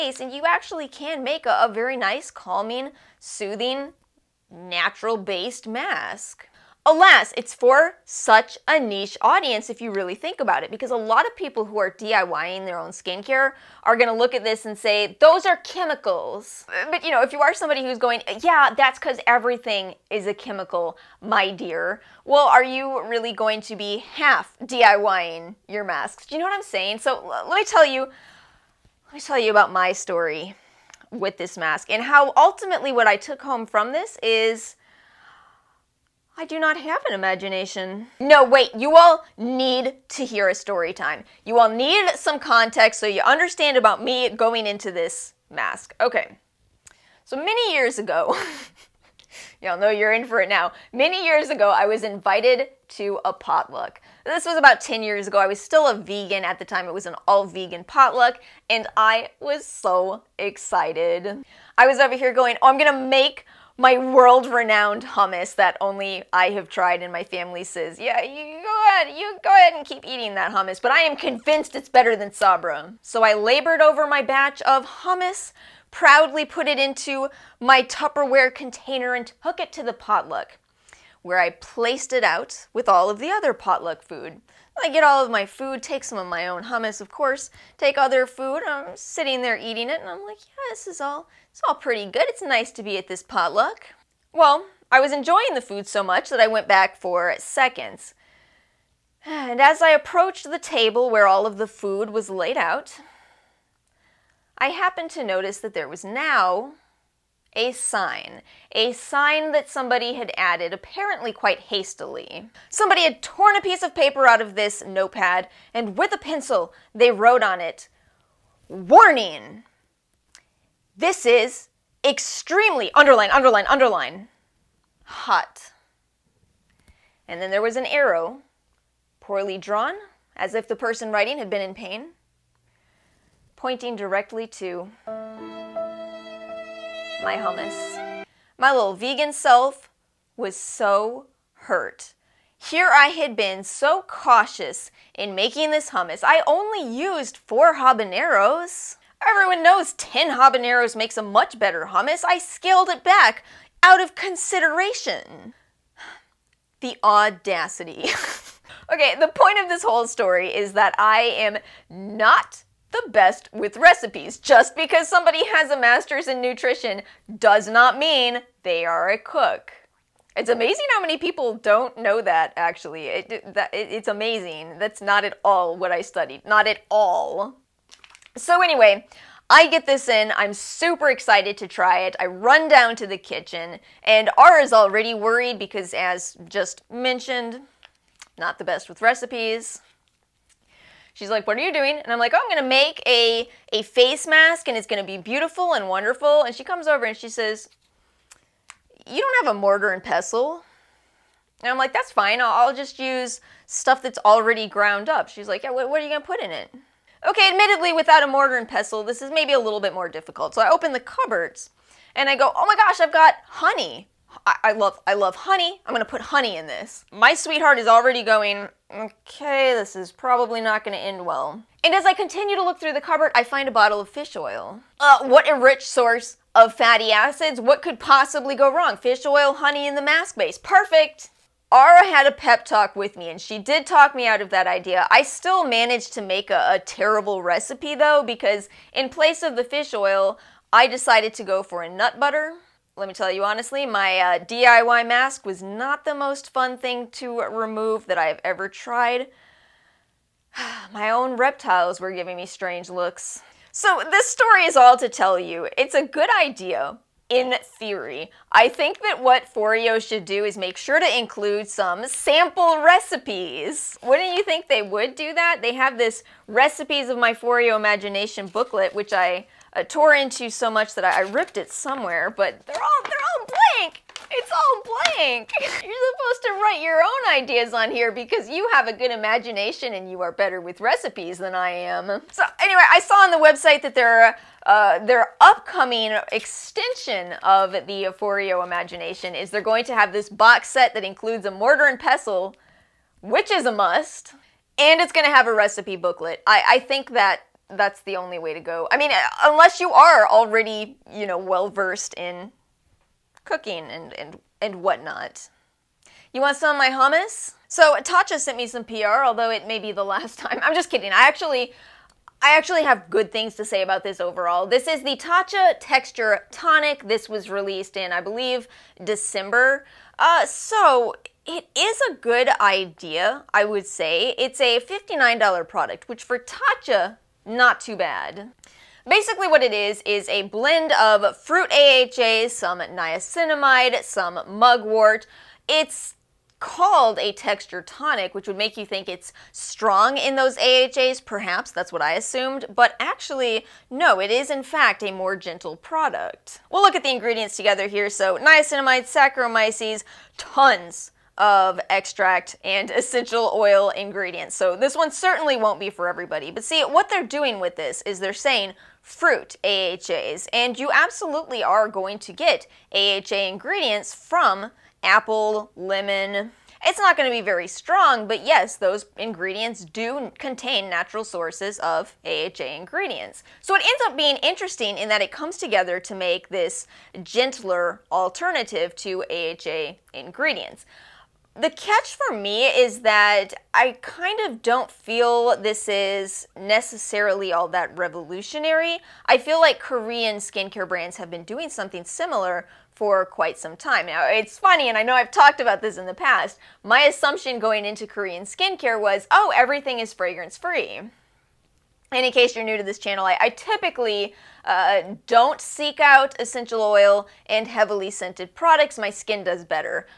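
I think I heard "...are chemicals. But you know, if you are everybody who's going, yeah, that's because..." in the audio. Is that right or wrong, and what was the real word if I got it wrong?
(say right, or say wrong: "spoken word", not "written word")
wrong: "somebody", not "everybody".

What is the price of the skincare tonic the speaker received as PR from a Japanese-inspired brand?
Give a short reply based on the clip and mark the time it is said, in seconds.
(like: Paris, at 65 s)
$59, at 324 s.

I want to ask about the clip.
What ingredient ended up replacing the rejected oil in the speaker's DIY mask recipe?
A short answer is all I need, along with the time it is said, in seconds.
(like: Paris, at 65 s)
Nut butter, at 241 s.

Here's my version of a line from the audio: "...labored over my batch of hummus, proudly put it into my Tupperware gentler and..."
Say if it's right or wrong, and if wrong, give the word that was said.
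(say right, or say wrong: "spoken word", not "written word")
wrong: "container", not "gentler".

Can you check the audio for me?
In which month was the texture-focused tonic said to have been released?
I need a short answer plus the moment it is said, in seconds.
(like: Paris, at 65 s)
December, at 319 s.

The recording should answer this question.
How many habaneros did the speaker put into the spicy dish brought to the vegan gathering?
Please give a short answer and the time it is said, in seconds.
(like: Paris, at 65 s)
4, at 147 s.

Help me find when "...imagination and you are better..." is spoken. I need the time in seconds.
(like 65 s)
279 s.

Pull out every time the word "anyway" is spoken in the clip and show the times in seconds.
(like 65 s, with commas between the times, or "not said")
178 s, 282 s.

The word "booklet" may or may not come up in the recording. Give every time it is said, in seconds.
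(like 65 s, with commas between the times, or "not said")
268 s, 295 s.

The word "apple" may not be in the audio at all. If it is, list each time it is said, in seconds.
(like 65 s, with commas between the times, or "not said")
365 s.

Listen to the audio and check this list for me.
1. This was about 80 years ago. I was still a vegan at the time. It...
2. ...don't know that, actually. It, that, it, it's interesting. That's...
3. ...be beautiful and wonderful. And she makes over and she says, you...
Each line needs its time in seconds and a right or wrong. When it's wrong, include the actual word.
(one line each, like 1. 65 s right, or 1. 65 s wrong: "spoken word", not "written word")
1. 54 s wrong: "10", not "80"
2. 171 s wrong: "amazing", not "interesting"
3. 195 s wrong: "comes", not "makes".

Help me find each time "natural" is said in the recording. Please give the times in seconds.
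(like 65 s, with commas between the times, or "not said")
4 s, 370 s.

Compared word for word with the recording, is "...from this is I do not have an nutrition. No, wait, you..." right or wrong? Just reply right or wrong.
wrong.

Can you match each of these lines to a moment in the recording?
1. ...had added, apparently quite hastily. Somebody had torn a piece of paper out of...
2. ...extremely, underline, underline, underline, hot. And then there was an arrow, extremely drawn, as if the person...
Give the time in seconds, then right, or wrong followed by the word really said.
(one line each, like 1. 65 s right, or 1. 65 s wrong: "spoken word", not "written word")
1. 110 s right
2. 122 s wrong: "poorly", not "extremely".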